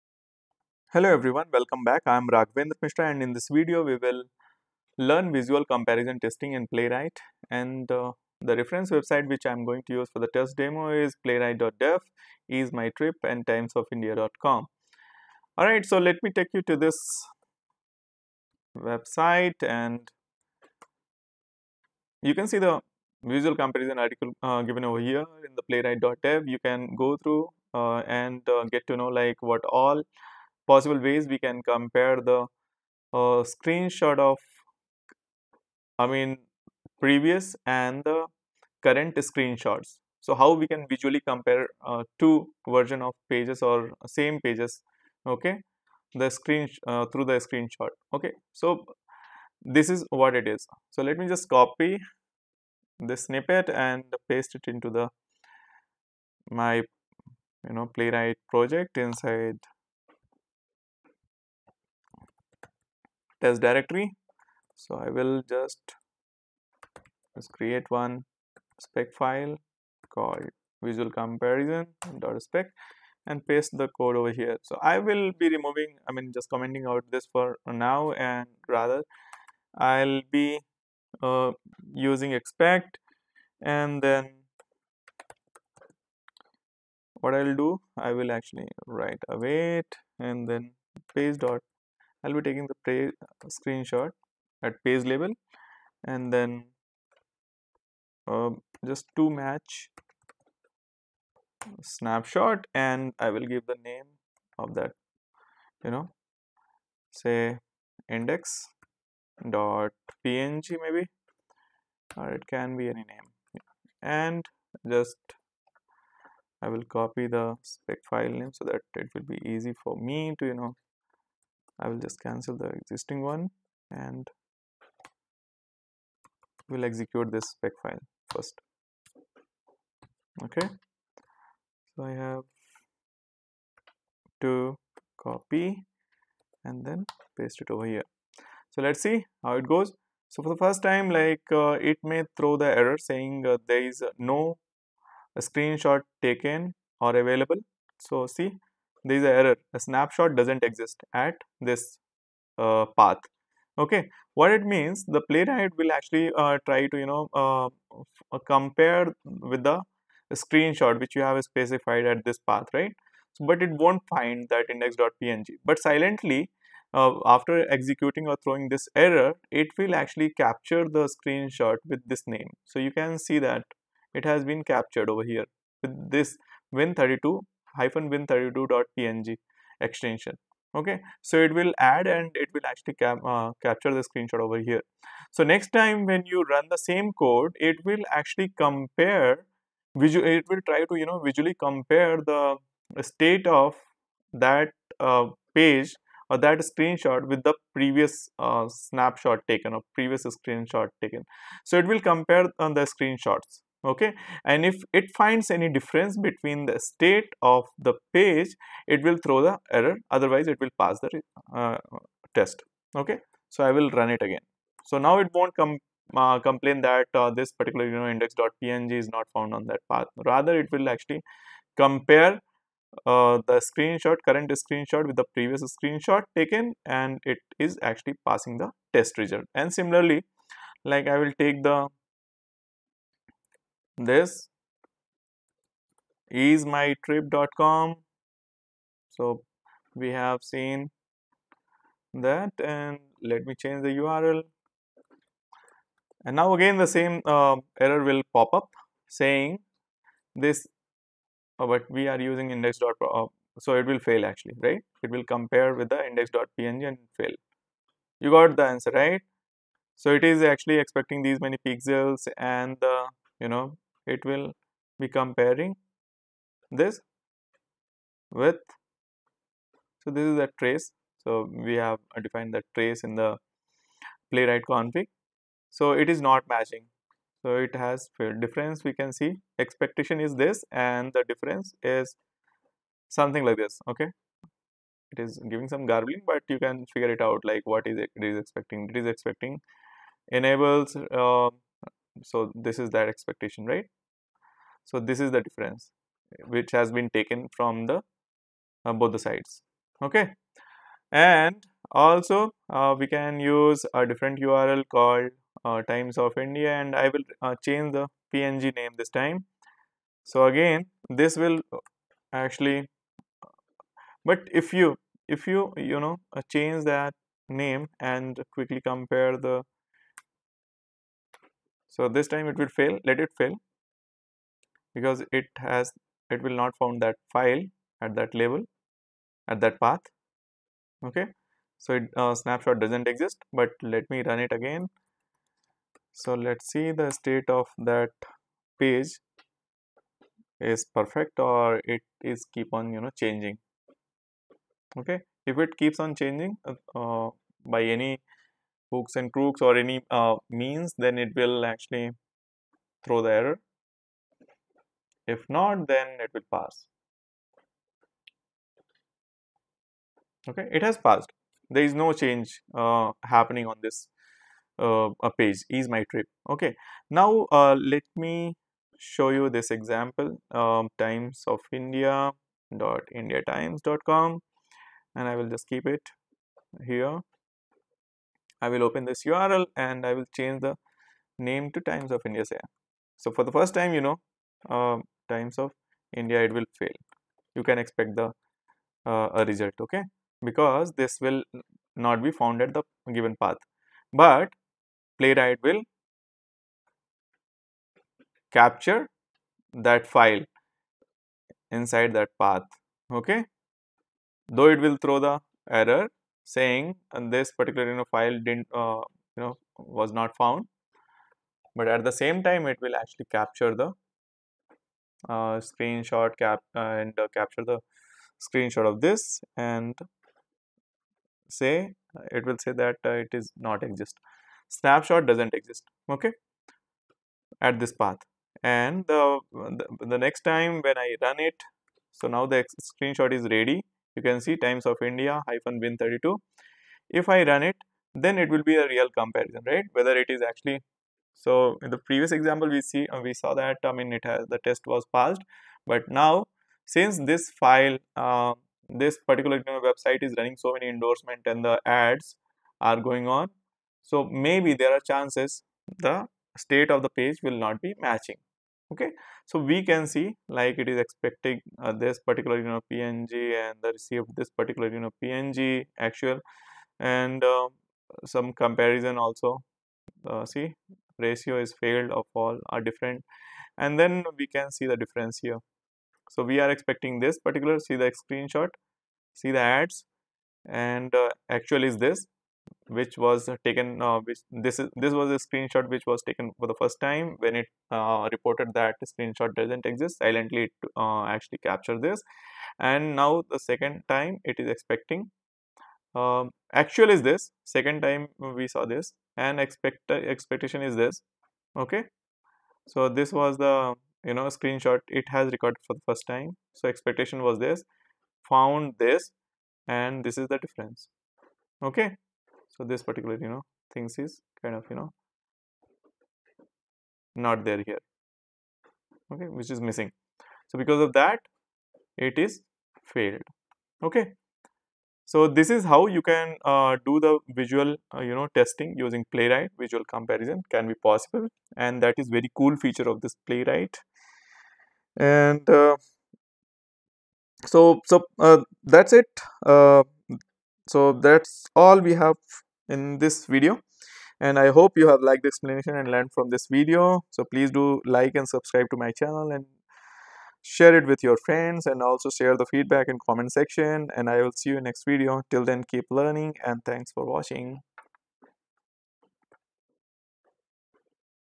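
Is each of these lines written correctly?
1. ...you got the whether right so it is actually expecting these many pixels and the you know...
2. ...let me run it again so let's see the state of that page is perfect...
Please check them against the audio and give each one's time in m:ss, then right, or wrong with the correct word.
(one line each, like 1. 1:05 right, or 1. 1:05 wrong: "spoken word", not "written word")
1. 4:18 wrong: "answer", not "whether"
2. 5:33 right.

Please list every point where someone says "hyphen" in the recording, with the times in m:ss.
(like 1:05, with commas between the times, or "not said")
2:57, 7:15.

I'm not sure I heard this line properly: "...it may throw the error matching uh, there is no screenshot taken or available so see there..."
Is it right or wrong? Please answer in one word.
wrong.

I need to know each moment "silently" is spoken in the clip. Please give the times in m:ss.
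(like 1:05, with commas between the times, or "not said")
2:45, 8:10.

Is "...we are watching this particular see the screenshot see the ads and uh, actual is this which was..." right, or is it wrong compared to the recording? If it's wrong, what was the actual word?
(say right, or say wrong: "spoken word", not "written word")
wrong: "expecting", not "watching".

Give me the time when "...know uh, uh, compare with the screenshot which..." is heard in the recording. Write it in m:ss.
2:37.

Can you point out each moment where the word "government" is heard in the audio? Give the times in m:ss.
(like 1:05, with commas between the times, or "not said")
not said.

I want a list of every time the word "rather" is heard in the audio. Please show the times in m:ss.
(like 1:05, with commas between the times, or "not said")
1:18, 3:40.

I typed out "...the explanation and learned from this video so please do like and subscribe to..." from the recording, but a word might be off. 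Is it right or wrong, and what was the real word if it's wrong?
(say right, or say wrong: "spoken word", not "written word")
right.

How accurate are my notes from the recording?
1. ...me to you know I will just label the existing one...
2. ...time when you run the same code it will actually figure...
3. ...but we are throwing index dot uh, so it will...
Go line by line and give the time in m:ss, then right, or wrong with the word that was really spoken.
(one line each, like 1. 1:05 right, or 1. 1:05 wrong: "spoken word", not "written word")
1. 1:59 wrong: "cancel", not "label"
2. 3:05 wrong: "compare", not "figure"
3. 4:11 wrong: "using", not "throwing".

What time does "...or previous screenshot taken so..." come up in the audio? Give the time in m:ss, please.
3:19.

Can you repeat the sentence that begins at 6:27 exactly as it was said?
You can expect the uh, a result, okay?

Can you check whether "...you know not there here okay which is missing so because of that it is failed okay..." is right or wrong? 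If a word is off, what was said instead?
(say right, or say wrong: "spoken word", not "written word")
right.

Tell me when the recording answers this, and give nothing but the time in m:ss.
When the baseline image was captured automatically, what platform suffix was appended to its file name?
2:57.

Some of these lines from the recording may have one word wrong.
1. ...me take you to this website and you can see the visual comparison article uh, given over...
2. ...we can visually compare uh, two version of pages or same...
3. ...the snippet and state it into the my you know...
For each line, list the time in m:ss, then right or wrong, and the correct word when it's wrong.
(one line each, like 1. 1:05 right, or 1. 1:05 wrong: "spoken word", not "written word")
1. 0:16 right
2. 0:40 right
3. 0:53 wrong: "paste", not "state".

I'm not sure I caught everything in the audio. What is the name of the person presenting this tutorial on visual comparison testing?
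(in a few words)
Raghavendra Mishra.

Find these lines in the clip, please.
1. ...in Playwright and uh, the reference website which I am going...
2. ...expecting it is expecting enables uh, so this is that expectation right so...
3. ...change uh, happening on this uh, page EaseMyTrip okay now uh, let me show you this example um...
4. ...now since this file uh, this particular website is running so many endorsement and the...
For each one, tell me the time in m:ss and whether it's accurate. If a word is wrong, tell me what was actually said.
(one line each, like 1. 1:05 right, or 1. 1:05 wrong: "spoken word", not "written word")
1. 0:06 right
2. 4:48 right
3. 6:02 right
4. 7:26 right.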